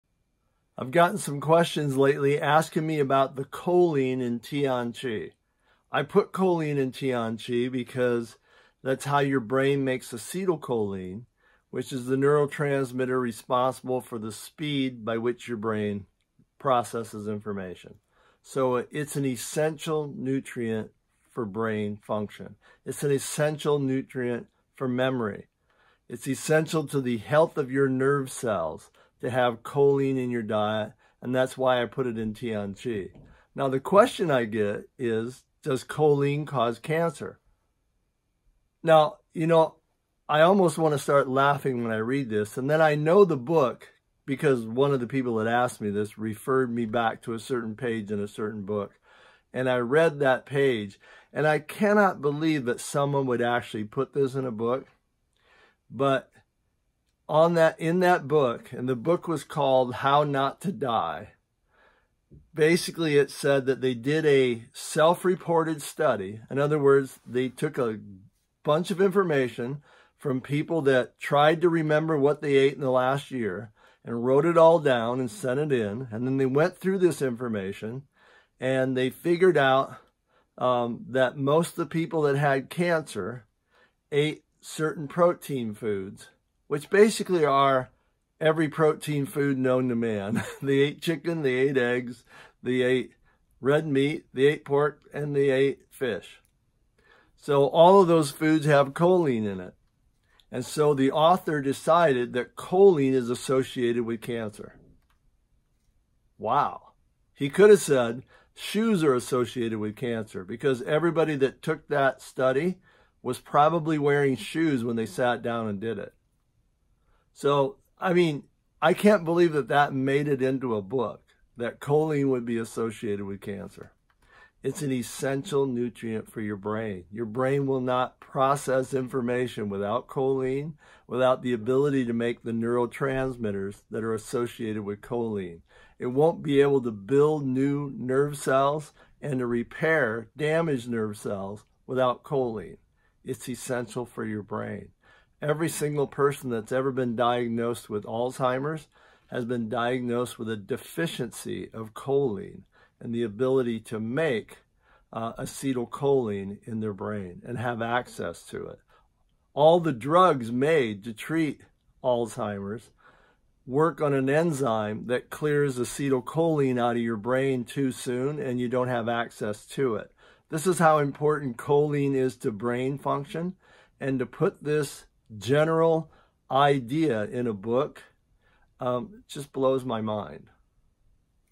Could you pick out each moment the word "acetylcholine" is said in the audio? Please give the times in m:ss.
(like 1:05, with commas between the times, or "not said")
0:10, 2:35, 2:45.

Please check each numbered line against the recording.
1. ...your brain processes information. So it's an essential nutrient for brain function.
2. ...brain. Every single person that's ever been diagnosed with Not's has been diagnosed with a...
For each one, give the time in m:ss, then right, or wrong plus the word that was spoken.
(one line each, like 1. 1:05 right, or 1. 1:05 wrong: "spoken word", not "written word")
1. 0:15 right
2. 2:24 wrong: "Alzheimer", not "Not".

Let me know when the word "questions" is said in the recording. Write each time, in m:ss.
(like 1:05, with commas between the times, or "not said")
0:01, 0:33.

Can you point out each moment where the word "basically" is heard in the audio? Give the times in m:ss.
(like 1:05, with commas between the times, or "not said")
1:02, 1:26.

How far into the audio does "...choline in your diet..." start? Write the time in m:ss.
0:29.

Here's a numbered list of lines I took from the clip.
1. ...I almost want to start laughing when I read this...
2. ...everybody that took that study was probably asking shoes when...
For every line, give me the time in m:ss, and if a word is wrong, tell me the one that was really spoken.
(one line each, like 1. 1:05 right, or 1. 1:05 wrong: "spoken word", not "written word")
1. 0:40 right
2. 1:50 wrong: "wearing", not "asking".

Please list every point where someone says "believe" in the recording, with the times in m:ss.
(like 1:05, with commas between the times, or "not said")
0:52, 1:59.